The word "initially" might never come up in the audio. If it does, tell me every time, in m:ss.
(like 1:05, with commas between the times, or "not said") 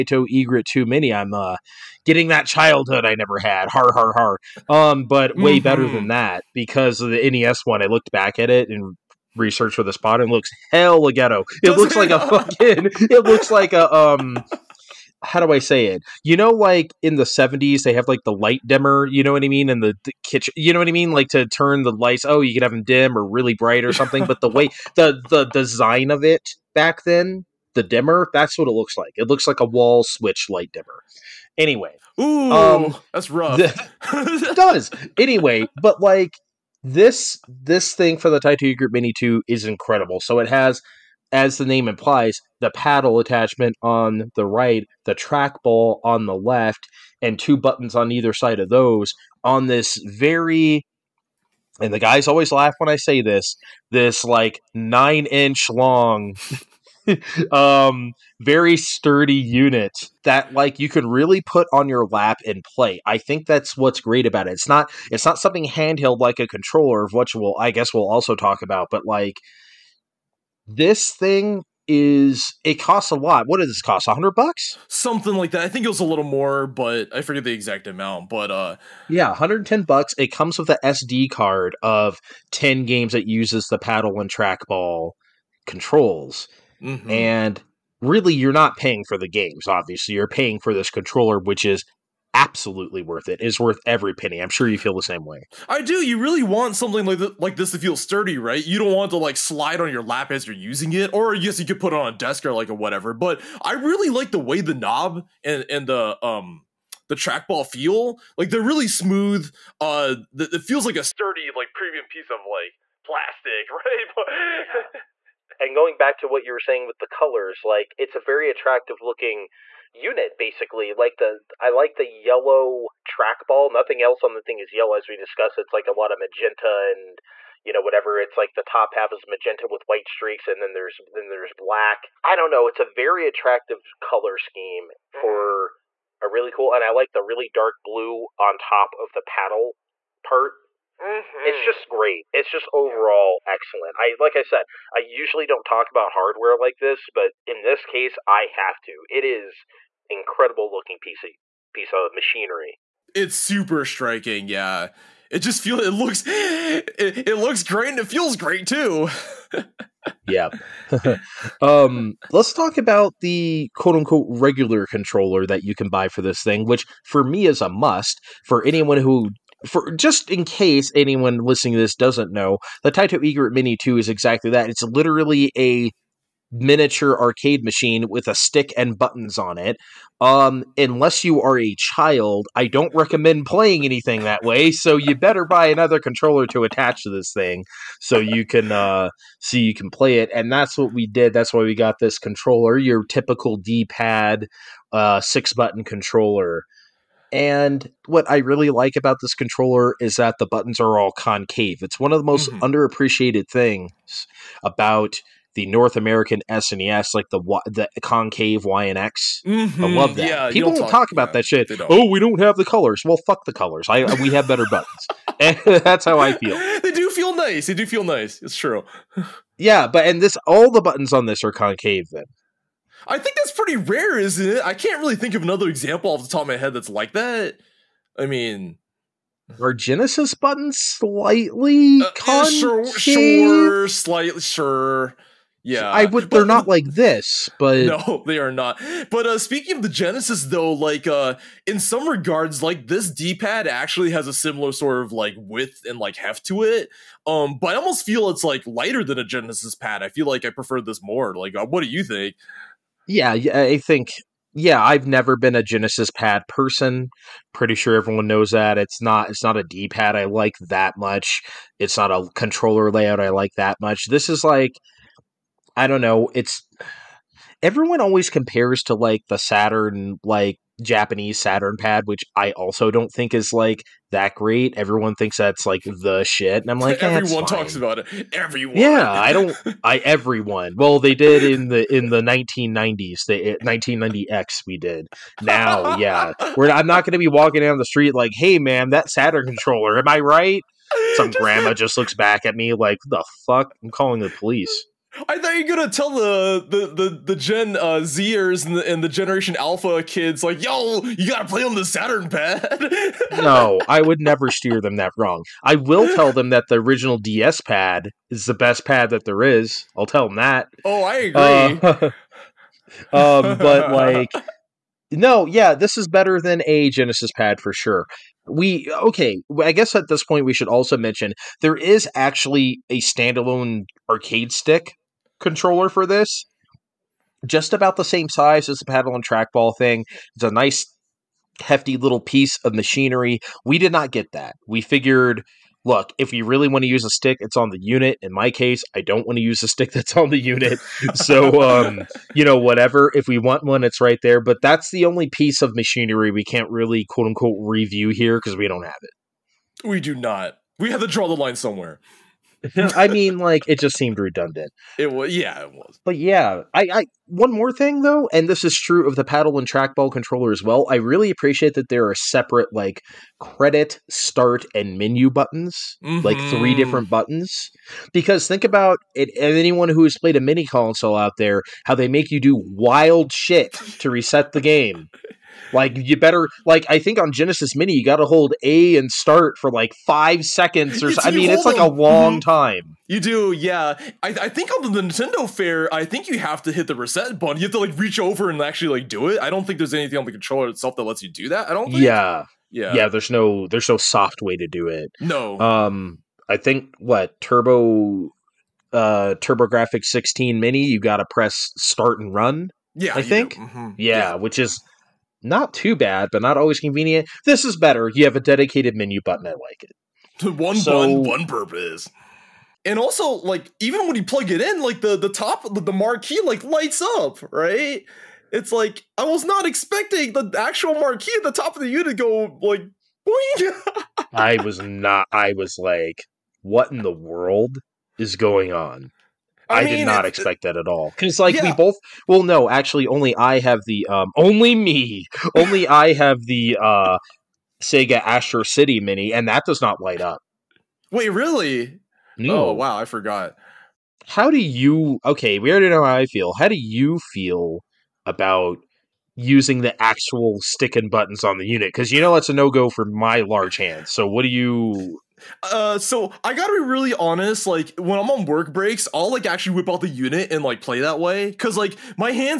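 not said.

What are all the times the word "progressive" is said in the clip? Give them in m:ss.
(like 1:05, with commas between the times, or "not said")
not said.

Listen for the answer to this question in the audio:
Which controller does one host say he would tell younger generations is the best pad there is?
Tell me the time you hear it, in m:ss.
5:06.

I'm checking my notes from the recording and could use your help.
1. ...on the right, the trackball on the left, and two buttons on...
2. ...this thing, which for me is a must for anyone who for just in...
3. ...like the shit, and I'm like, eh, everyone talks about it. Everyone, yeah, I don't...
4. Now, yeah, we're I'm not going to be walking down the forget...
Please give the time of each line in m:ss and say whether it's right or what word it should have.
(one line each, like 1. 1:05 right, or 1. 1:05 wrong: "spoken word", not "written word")
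1. 0:43 right
2. 2:46 right
3. 4:35 right
4. 4:45 wrong: "street", not "forget".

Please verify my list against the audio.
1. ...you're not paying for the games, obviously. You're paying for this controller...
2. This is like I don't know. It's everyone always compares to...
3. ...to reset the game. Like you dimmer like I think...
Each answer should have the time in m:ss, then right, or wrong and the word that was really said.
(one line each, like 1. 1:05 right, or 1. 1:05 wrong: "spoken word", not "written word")
1. 1:28 right
2. 4:24 right
3. 6:13 wrong: "better", not "dimmer".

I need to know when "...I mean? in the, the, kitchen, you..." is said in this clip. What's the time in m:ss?
0:19.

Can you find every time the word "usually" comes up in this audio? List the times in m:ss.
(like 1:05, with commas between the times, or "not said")
2:24.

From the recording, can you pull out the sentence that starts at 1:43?
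But I really like the way the knob and and the um the trackball feel.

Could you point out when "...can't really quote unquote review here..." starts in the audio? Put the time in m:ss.
5:46.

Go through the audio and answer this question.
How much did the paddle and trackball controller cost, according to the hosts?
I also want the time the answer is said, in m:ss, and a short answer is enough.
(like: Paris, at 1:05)
$110, at 1:19.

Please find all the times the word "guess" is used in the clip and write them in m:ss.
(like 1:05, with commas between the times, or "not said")
1:07, 5:19.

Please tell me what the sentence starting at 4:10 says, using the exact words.
I feel like I prefer this more.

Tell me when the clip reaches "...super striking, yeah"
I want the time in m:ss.
2:33.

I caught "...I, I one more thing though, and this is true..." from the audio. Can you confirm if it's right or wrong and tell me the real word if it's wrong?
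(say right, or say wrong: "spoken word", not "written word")
right.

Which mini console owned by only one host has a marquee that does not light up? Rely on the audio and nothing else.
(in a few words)
Sega Astro City Mini.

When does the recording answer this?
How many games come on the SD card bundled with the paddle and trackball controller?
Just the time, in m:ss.
1:22.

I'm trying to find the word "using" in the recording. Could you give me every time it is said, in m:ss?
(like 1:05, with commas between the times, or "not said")
1:40, 7:29.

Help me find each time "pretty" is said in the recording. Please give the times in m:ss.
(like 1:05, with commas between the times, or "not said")
3:43, 4:17.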